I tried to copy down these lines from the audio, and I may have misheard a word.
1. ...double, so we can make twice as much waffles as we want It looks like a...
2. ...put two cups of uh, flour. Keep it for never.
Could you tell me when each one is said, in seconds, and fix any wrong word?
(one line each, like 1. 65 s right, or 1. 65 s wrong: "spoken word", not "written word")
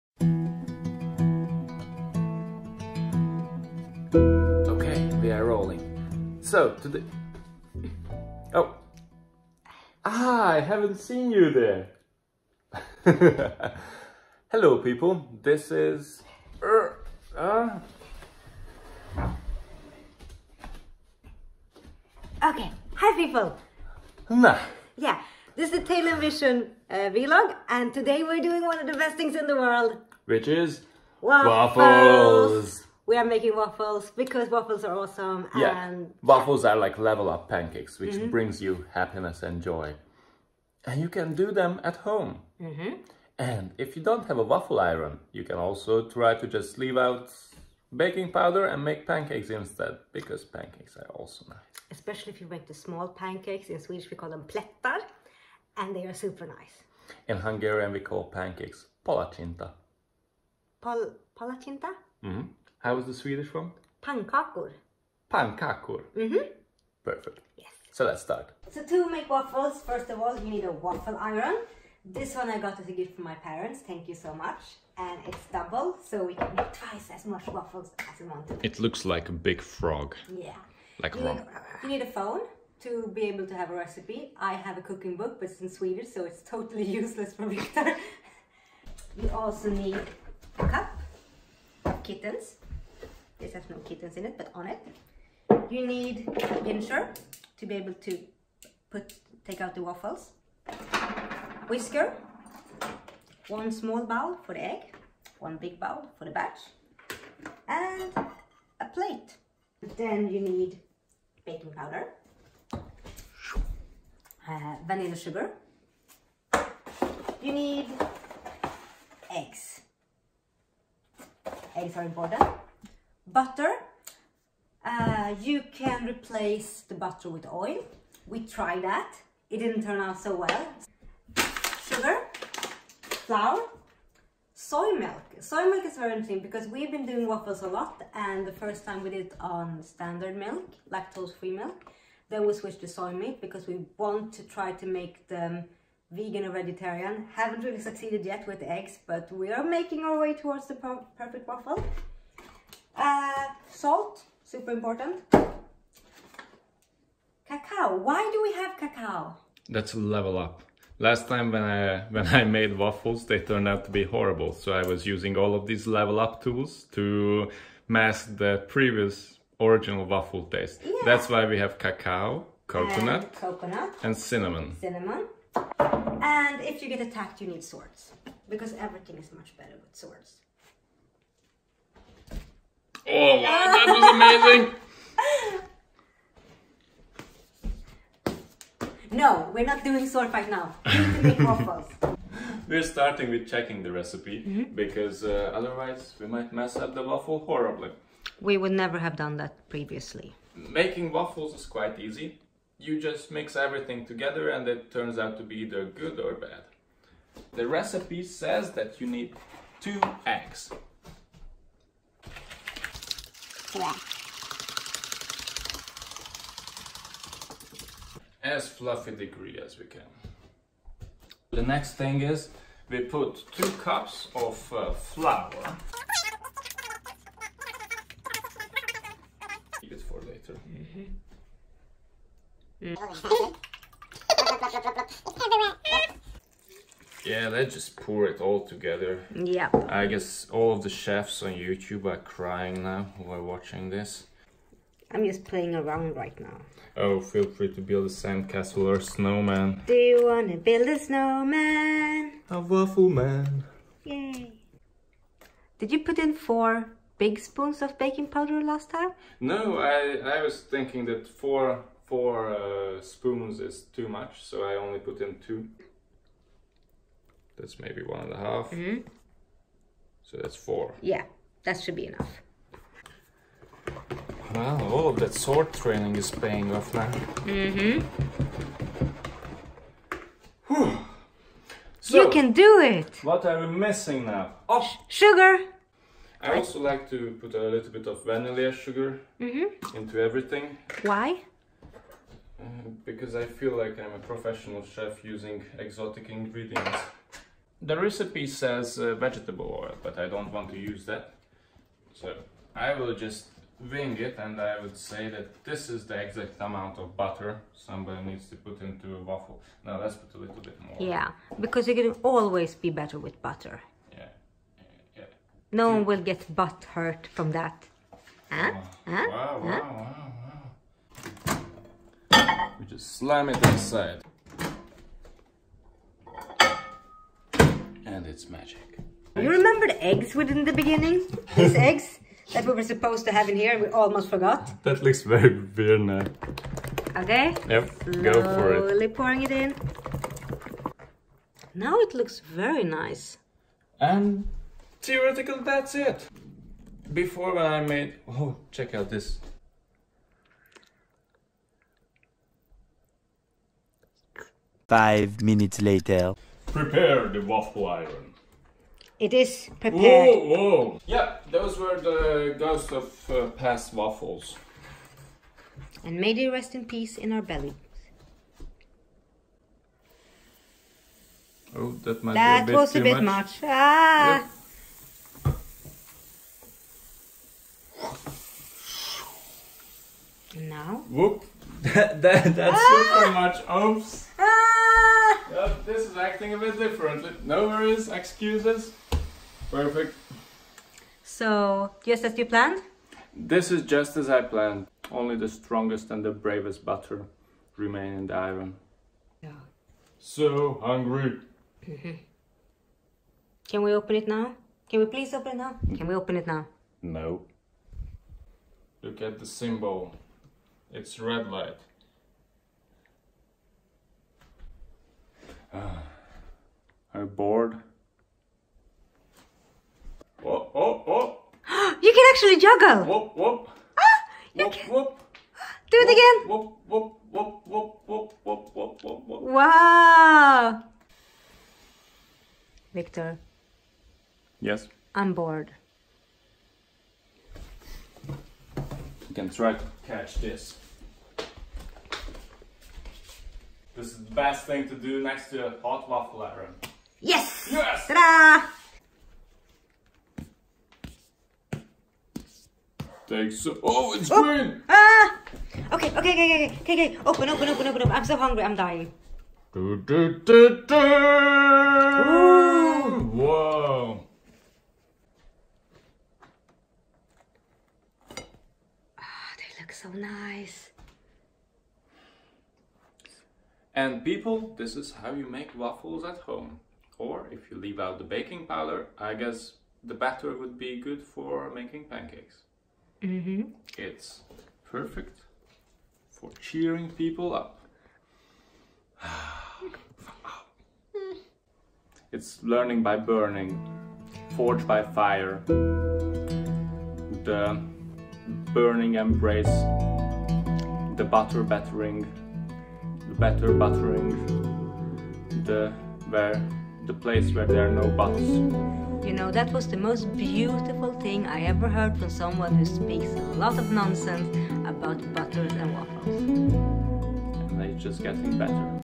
1. 75 s right
2. 223 s wrong: "later", not "never".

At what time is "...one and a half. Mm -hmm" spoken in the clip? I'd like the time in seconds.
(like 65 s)
268 s.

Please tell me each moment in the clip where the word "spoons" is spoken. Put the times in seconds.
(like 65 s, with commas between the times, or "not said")
257 s, 263 s.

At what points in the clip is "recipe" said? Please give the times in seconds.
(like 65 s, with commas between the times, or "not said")
83 s, 193 s, 207 s, 297 s.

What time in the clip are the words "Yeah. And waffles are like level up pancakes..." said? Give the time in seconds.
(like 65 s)
35 s.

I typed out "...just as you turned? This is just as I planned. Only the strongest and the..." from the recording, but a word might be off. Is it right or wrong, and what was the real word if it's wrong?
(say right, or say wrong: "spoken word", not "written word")
wrong: "planned", not "turned".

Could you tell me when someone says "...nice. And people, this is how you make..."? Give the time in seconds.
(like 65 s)
470 s.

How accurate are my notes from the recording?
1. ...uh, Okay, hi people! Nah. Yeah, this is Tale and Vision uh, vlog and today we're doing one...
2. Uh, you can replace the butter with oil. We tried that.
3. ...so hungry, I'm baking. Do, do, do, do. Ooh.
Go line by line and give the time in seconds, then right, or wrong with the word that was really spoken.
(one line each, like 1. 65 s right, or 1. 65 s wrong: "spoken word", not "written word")
1. 17 s right
2. 124 s right
3. 458 s wrong: "dying", not "baking".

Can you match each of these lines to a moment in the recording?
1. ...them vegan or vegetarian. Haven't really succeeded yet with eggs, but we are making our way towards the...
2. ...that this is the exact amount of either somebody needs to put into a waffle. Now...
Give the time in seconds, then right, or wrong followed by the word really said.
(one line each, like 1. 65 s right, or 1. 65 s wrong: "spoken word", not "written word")
1. 145 s right
2. 305 s wrong: "butter", not "either".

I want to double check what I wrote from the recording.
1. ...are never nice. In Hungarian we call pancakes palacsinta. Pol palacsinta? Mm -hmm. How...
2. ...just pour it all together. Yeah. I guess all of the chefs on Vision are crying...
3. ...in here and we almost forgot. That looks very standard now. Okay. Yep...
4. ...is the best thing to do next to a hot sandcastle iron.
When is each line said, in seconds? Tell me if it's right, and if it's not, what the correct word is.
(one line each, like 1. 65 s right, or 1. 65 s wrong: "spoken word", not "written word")
1. 56 s wrong: "super", not "never"
2. 237 s wrong: "YouTube", not "Vision"
3. 333 s wrong: "weird", not "standard"
4. 444 s wrong: "waffle", not "sandcastle".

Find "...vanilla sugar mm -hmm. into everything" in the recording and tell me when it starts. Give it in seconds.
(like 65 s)
288 s.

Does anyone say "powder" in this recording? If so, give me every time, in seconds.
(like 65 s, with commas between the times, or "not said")
48 s, 111 s, 258 s, 478 s.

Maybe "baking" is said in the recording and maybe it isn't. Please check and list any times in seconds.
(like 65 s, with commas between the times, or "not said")
48 s, 111 s, 257 s, 478 s.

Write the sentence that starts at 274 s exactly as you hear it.
Well, all of that sword training is paying off now.